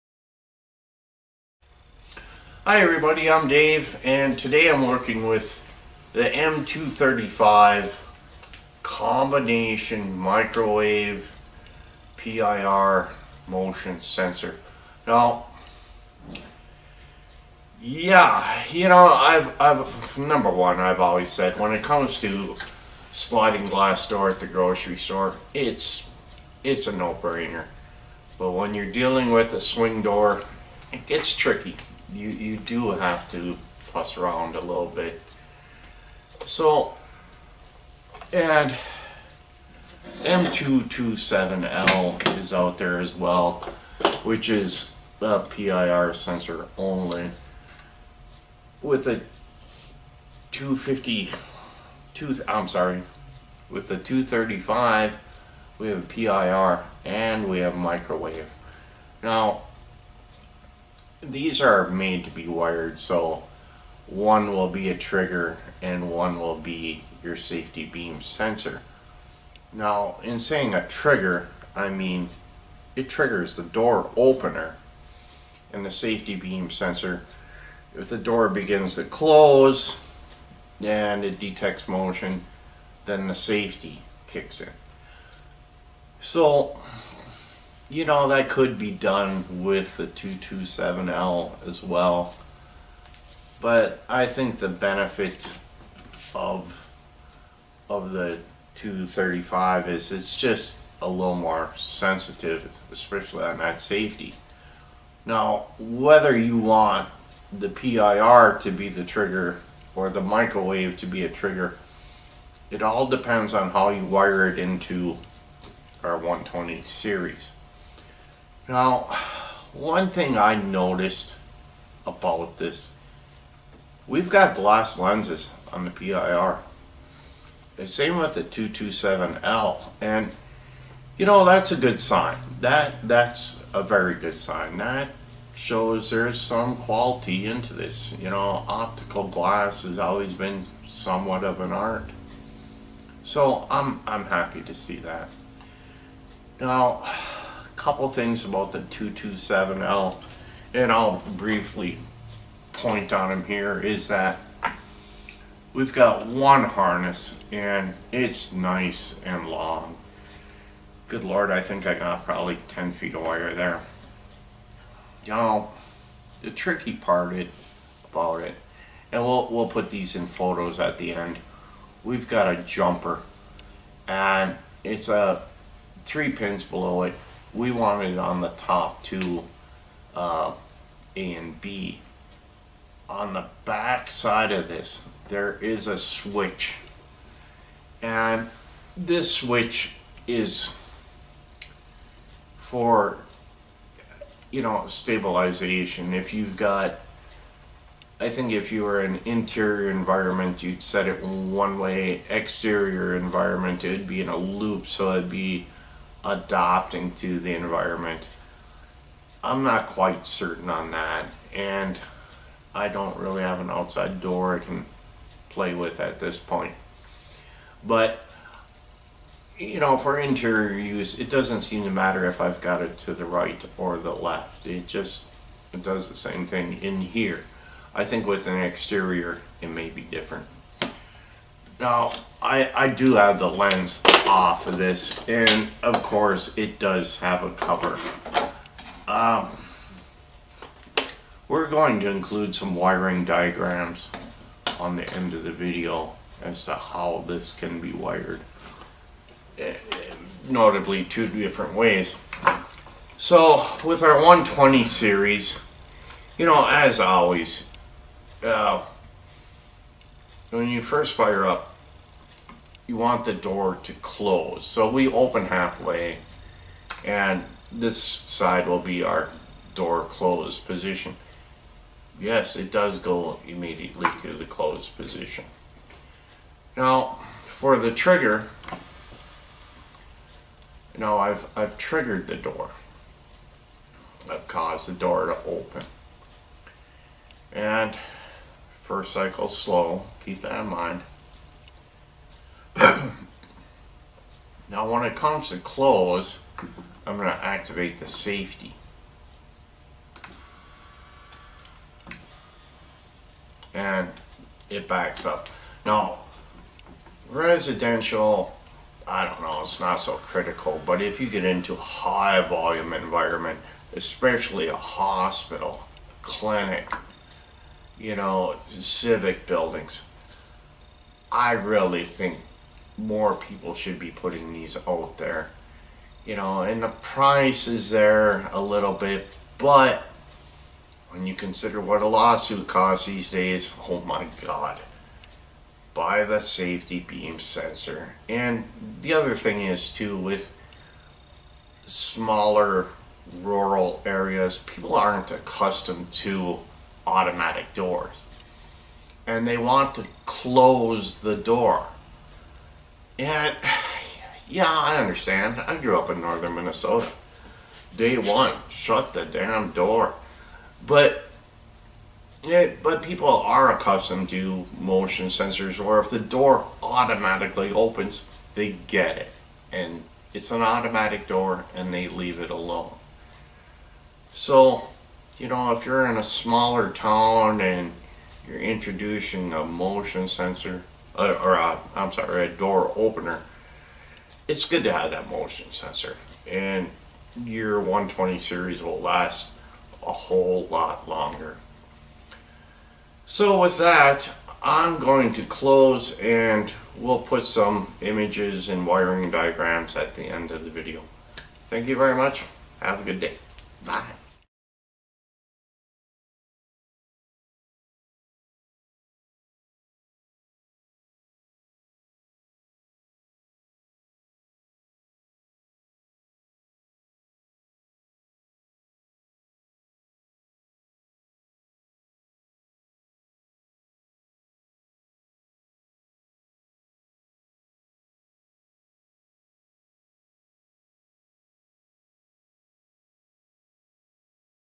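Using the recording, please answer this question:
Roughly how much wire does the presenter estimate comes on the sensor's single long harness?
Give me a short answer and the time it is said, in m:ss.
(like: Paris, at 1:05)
10 feet, at 2:42.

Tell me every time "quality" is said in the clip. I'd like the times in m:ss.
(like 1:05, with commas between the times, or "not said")
2:16.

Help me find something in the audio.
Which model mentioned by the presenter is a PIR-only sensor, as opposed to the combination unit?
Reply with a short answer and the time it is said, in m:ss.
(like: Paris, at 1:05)
M227L, at 0:40.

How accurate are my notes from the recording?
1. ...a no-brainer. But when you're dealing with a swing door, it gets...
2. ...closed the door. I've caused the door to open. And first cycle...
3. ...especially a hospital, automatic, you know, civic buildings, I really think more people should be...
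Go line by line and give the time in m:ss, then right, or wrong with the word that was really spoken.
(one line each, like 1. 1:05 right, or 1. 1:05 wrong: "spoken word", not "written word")
1. 0:26 right
2. 4:41 wrong: "triggered", not "closed"
3. 5:13 wrong: "clinic", not "automatic".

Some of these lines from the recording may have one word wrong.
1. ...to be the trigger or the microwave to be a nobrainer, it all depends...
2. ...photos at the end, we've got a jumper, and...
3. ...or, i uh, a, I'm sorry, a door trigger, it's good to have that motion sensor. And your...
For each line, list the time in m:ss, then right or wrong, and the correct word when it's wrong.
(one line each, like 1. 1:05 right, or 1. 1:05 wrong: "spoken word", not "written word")
1. 1:48 wrong: "trigger", not "nobrainer"
2. 2:50 right
3. 6:21 wrong: "opener", not "trigger".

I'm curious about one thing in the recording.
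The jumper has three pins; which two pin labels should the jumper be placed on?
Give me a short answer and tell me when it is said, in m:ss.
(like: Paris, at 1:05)
A and B, at 3:01.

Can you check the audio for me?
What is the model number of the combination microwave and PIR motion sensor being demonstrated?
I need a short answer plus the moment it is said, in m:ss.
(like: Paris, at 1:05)
M235, at 0:06.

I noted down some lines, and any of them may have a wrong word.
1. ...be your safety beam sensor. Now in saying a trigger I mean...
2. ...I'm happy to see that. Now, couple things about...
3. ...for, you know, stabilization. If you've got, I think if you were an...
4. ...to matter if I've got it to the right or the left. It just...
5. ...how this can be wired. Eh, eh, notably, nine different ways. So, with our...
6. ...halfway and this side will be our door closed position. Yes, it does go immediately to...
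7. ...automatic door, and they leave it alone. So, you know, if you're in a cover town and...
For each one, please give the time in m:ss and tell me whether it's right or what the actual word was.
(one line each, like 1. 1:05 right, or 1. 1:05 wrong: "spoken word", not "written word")
1. 1:06 right
2. 2:24 right
3. 3:12 right
4. 3:41 right
5. 4:06 wrong: "two", not "nine"
6. 4:25 right
7. 6:10 wrong: "smaller", not "cover".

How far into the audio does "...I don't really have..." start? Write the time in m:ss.
3:32.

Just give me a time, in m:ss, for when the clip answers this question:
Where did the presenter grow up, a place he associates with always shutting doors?
5:56.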